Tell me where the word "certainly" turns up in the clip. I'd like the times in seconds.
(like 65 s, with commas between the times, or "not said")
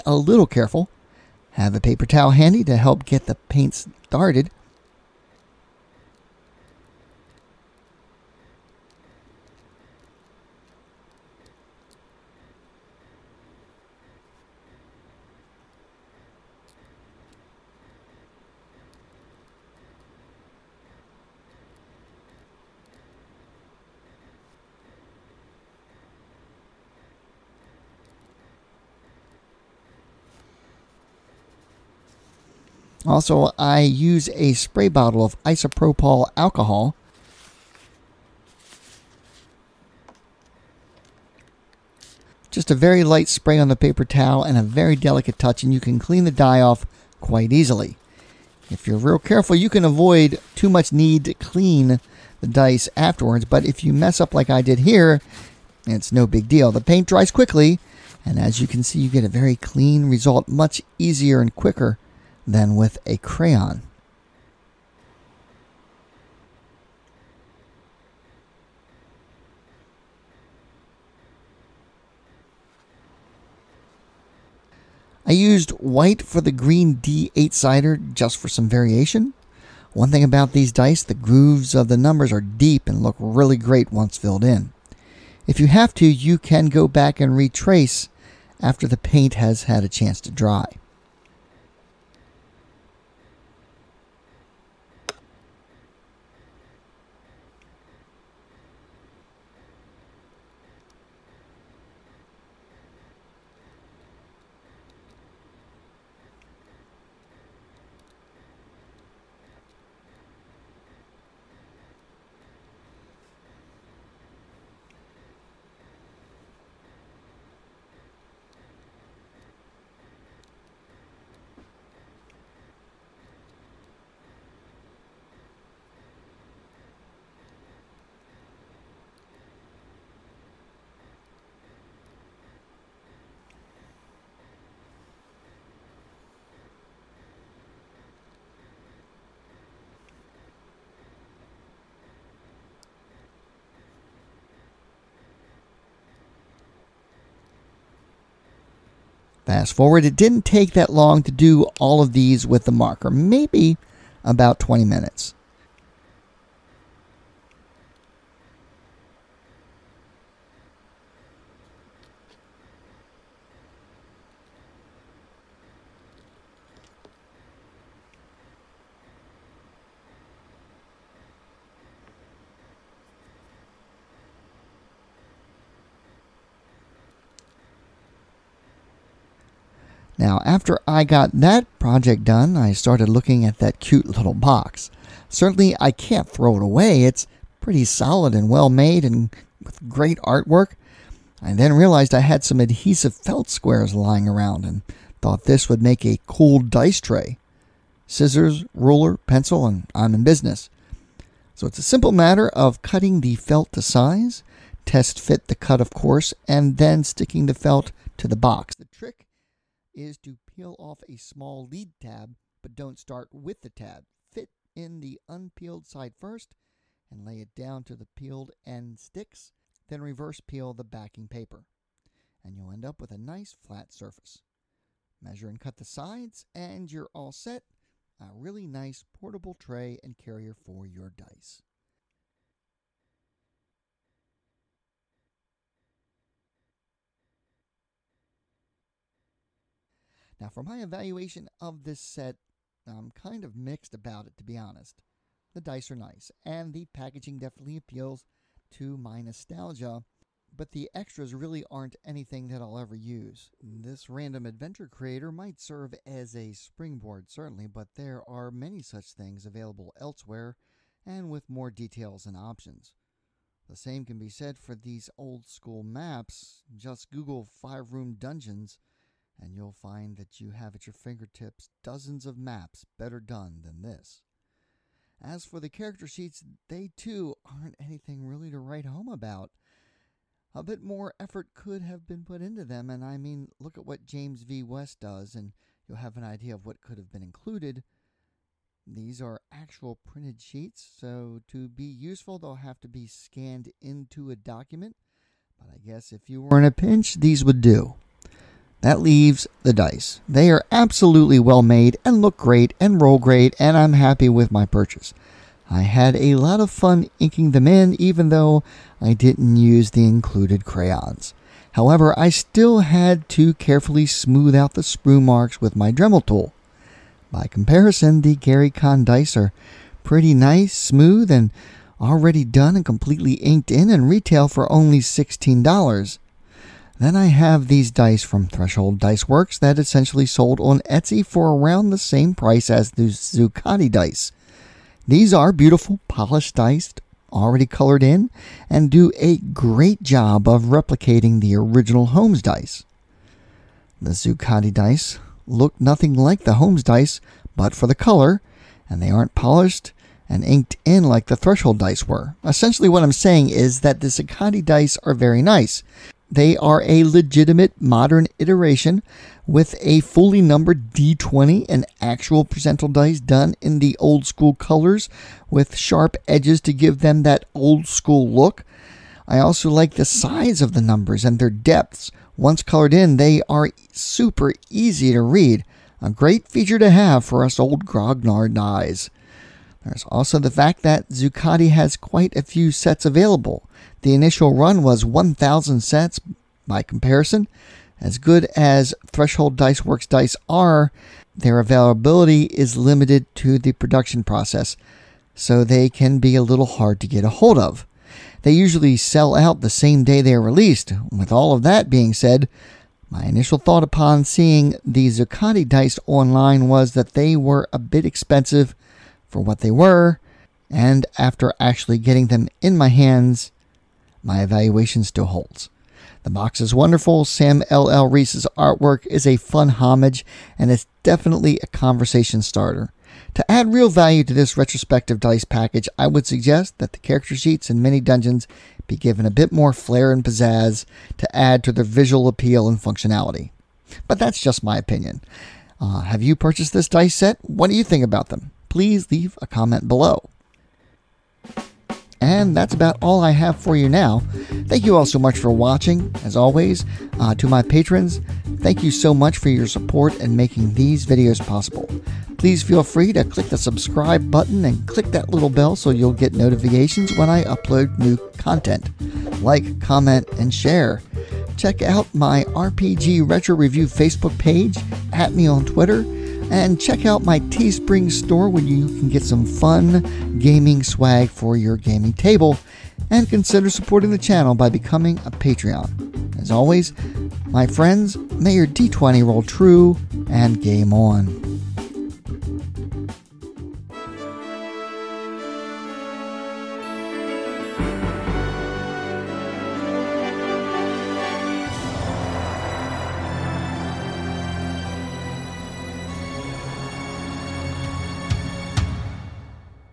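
185 s, 257 s.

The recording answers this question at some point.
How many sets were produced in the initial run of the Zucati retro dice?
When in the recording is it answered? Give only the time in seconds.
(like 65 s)
385 s.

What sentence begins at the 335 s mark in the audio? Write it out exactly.
These are beautiful, polished dice, already colored in, and do a great job of replicating the original Holmes dice.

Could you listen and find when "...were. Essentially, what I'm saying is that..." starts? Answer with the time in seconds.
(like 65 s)
352 s.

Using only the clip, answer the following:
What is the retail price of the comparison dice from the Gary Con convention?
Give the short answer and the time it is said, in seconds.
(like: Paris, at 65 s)
$16, at 324 s.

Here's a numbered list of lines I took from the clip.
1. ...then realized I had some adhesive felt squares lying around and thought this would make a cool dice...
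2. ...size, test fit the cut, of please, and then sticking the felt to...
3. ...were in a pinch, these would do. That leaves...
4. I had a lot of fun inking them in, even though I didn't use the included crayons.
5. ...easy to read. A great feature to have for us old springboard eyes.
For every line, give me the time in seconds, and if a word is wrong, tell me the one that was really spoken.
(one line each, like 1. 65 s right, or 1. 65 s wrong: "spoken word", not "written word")
1. 191 s right
2. 203 s wrong: "course", not "please"
3. 296 s right
4. 305 s right
5. 374 s wrong: "grognard", not "springboard".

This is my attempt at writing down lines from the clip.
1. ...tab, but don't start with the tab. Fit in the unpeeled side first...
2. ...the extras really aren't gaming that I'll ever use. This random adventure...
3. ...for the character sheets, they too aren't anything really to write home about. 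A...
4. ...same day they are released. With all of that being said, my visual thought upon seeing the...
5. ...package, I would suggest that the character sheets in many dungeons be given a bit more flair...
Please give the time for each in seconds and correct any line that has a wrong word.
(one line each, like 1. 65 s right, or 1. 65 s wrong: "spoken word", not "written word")
1. 211 s right
2. 250 s wrong: "anything", not "gaming"
3. 275 s right
4. 399 s wrong: "initial", not "visual"
5. 425 s right.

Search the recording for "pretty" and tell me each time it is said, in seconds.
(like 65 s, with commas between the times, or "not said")
187 s, 320 s.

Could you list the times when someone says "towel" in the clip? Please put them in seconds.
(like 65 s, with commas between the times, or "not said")
2 s, 44 s.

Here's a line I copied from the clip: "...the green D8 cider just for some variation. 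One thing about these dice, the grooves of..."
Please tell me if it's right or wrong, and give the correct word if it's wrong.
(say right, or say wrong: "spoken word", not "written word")
right.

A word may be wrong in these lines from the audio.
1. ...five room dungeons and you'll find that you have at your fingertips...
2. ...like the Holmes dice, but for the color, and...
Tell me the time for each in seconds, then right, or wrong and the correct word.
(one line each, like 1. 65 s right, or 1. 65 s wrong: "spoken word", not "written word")
1. 267 s right
2. 346 s right.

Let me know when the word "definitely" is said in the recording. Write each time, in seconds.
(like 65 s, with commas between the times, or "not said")
247 s, 421 s.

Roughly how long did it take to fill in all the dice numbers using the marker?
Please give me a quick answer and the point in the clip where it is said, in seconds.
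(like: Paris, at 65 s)
20 minutes, at 154 s.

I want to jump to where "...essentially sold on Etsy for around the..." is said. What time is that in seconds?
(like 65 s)
329 s.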